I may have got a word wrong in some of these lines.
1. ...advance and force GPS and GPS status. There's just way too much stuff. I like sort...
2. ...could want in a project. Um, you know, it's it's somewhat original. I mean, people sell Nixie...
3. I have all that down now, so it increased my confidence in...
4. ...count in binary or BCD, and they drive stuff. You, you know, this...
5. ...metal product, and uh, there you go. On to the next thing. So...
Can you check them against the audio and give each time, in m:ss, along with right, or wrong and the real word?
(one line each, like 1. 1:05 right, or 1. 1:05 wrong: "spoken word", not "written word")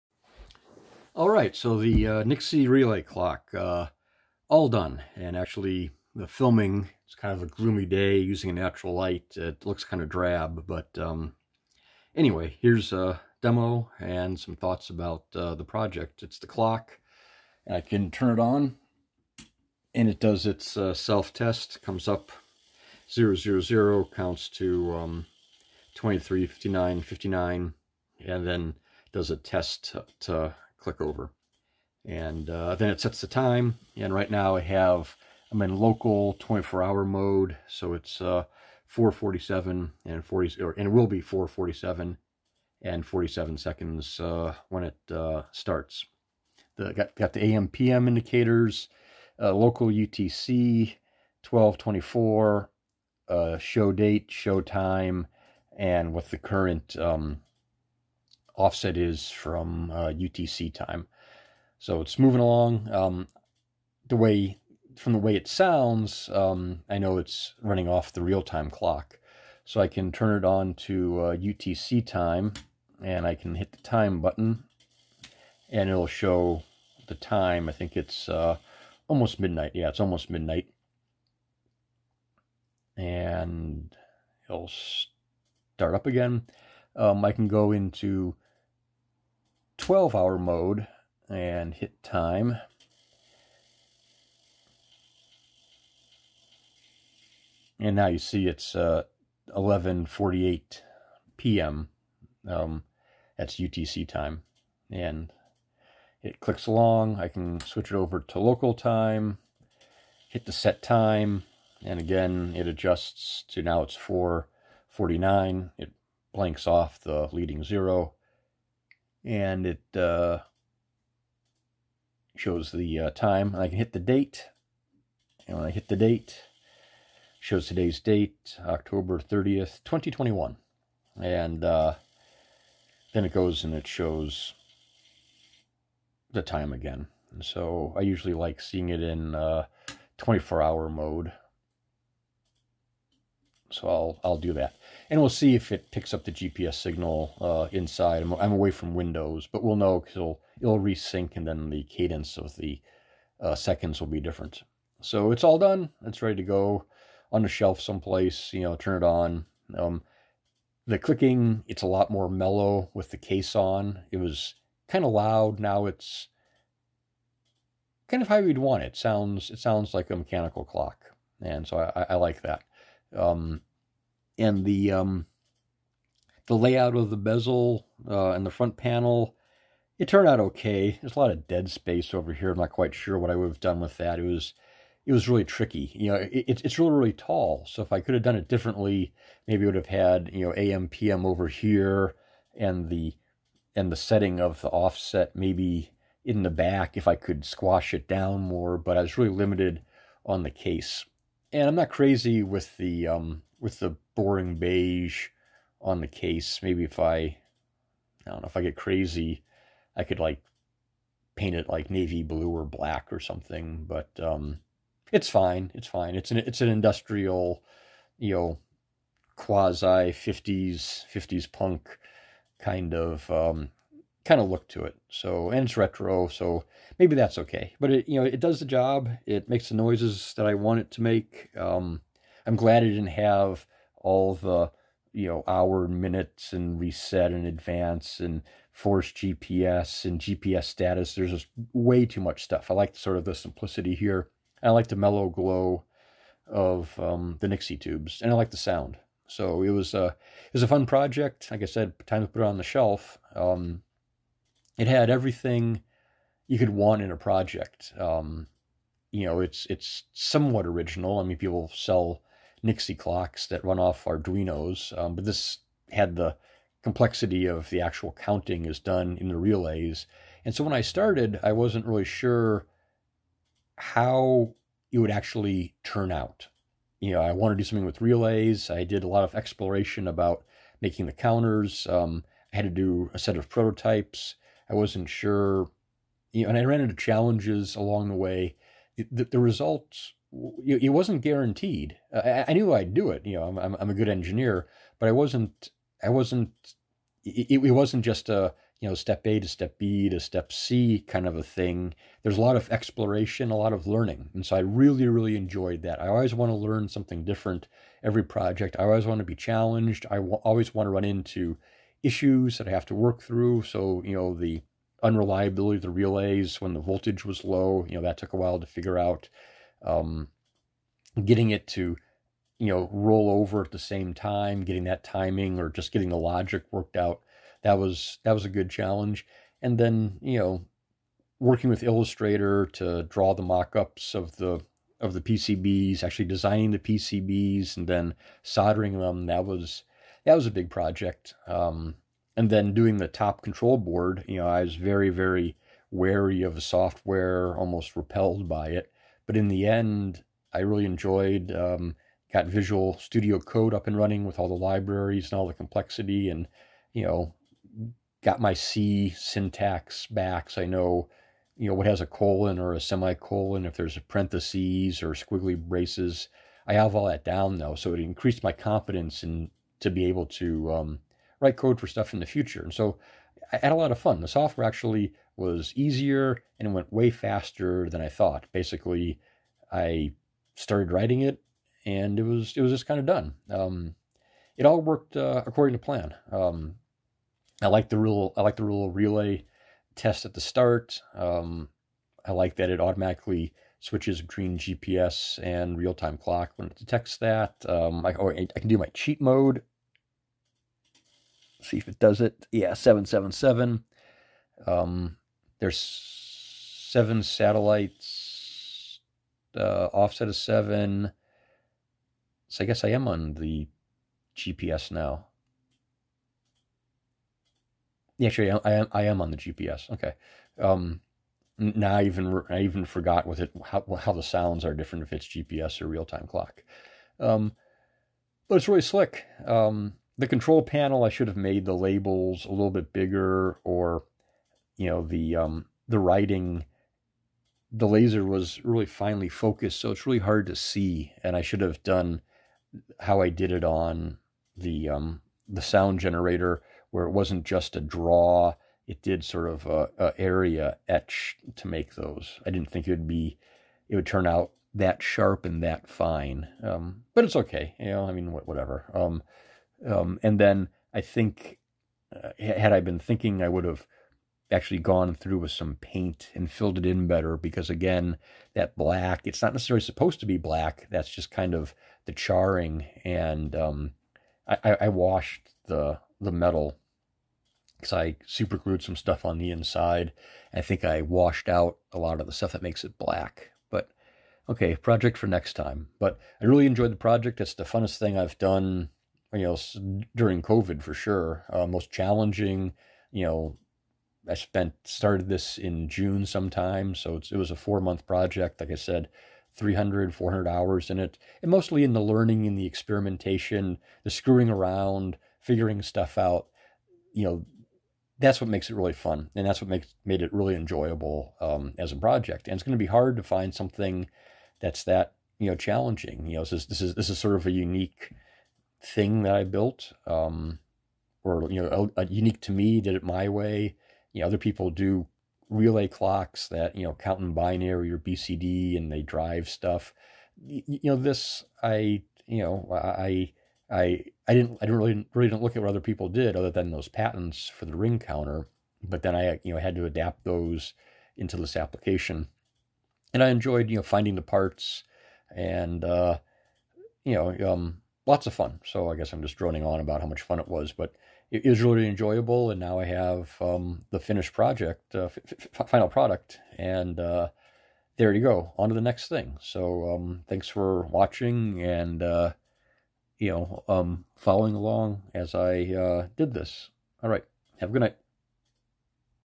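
1. 3:57 right
2. 4:16 right
3. 6:06 right
4. 8:46 right
5. 9:15 wrong: "final", not "metal".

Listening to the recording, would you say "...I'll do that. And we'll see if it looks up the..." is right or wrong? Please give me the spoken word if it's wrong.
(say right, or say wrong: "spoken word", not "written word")
wrong: "picks", not "looks".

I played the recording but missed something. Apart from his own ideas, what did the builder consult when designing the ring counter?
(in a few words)
patents.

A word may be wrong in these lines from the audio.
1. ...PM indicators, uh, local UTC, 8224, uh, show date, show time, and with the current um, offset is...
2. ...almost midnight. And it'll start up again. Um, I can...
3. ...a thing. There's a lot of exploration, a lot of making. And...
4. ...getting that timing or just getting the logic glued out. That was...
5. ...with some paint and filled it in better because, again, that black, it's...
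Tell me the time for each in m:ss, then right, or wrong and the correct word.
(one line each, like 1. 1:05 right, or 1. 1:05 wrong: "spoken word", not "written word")
1. 0:47 wrong: "1224", not "8224"
2. 1:19 right
3. 5:01 wrong: "learning", not "making"
4. 5:24 wrong: "worked", not "glued"
5. 7:45 right.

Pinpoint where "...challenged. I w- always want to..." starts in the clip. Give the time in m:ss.
5:09.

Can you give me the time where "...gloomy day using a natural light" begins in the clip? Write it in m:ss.
0:07.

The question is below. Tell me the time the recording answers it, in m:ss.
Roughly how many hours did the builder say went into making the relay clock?
8:19.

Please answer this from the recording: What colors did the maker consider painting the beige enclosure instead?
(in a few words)
navy blue or black.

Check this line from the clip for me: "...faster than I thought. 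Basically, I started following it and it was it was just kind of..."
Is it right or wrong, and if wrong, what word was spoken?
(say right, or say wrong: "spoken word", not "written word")
wrong: "writing", not "following".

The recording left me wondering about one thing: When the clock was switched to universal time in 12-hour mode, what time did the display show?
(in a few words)
11:48 p.m.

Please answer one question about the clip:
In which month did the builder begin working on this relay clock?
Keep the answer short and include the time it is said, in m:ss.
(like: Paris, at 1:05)
June, at 8:15.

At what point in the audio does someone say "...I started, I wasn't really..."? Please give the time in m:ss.
4:30.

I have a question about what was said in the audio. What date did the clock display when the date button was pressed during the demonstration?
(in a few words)
October 30th, 2021.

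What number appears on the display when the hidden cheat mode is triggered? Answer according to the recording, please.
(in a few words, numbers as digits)
777.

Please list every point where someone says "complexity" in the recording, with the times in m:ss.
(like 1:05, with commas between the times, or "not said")
4:26, 5:55.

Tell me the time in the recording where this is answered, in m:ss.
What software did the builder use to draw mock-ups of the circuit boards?
5:31.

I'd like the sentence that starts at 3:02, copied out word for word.
I'm not quite sure what I would have done with that.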